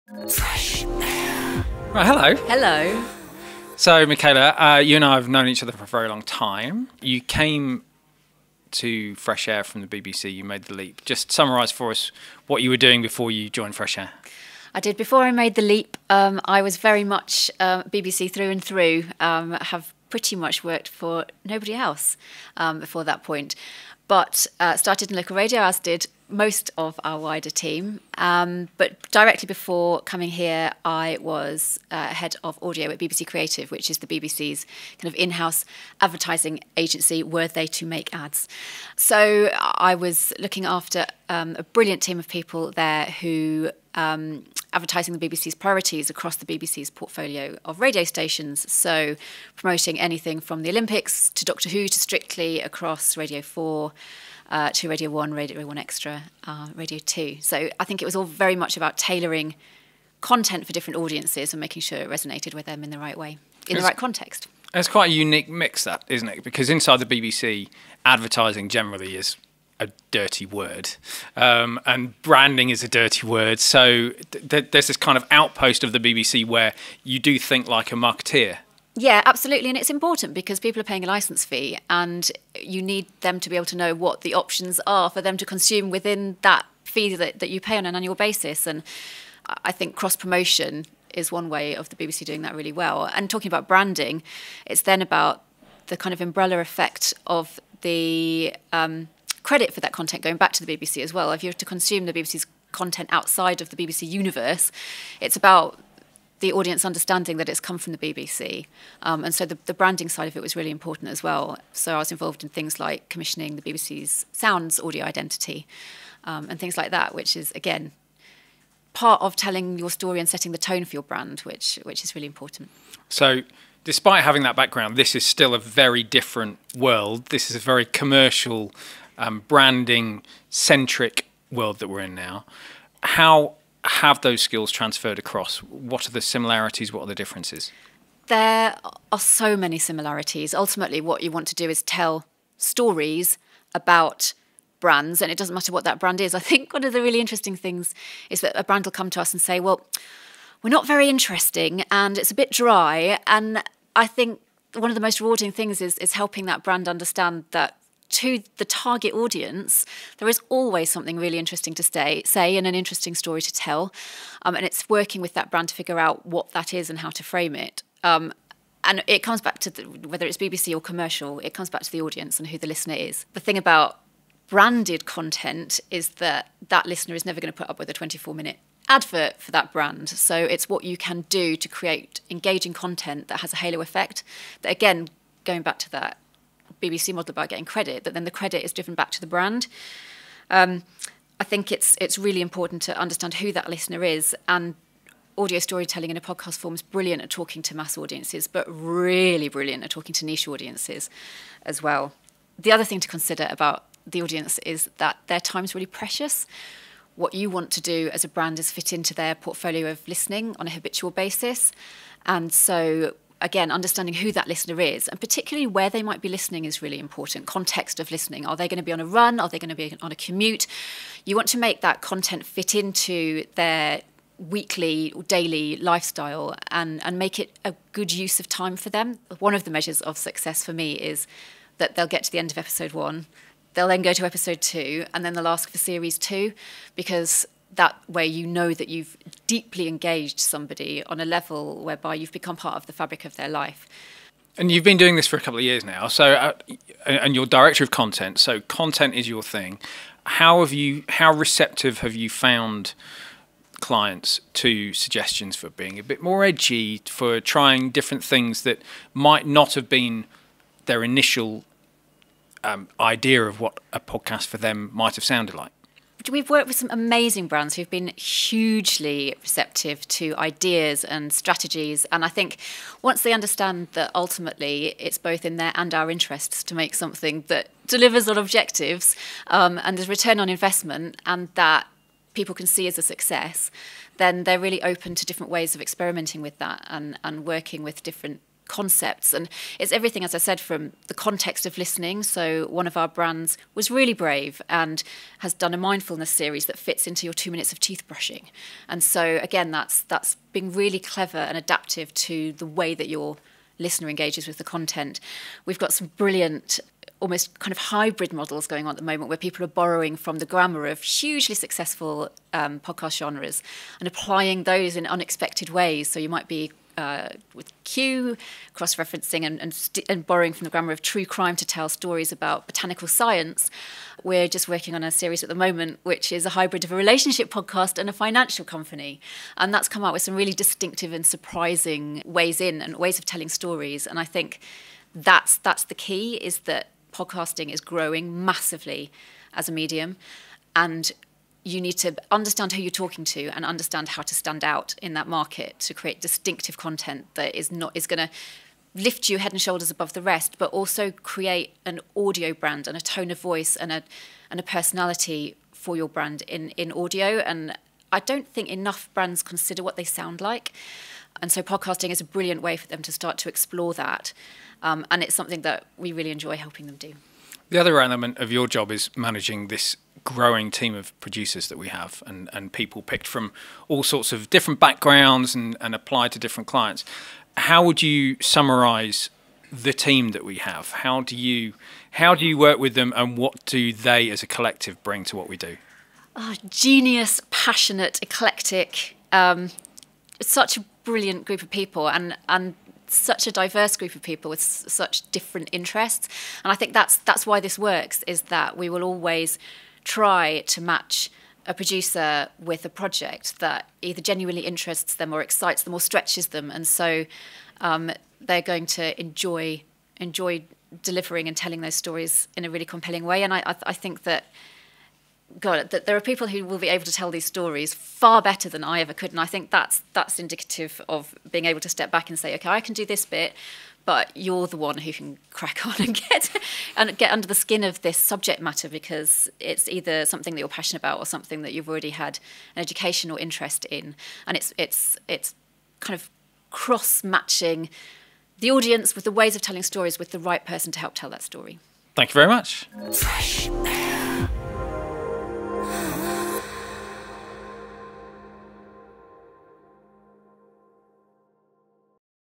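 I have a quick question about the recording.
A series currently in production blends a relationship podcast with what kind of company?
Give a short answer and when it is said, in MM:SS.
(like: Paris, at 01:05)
financial company, at 05:28.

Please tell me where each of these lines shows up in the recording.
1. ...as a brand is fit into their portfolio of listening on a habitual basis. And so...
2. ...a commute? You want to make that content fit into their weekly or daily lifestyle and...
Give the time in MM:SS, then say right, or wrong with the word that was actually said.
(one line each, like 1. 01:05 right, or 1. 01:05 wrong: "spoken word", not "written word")
1. 03:28 right
2. 03:40 right.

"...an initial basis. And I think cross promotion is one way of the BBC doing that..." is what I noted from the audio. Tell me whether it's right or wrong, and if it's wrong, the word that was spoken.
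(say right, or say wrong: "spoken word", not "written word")
wrong: "annual", not "initial".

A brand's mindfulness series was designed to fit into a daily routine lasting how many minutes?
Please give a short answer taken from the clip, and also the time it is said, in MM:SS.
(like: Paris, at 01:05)
2, at 04:57.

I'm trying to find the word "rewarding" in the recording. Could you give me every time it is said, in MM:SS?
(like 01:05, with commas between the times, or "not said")
02:35.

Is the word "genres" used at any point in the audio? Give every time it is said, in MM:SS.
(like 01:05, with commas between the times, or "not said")
05:13.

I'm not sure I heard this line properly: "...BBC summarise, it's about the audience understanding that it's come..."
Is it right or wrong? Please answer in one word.
wrong.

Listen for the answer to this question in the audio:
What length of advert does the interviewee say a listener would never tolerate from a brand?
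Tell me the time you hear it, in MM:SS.
02:57.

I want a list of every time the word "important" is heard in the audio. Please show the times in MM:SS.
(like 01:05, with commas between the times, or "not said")
01:19, 01:50, 02:02, 03:12, 03:36.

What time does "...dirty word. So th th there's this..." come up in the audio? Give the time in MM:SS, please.
01:12.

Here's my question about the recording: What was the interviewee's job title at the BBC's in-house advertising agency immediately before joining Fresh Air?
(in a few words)
head of audio.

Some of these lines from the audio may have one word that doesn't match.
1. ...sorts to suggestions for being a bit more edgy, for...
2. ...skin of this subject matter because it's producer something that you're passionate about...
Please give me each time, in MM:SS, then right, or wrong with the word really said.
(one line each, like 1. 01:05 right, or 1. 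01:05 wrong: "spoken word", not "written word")
1. 04:13 wrong: "clients", not "sorts"
2. 07:07 wrong: "either", not "producer".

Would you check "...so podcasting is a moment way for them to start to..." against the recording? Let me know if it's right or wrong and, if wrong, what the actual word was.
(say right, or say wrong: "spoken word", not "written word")
wrong: "brilliant", not "moment".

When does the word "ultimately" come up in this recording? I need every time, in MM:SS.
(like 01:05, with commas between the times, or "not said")
02:20, 04:34.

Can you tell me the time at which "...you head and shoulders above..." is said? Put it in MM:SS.
05:49.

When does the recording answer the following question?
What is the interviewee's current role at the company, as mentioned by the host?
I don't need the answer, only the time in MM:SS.
04:07.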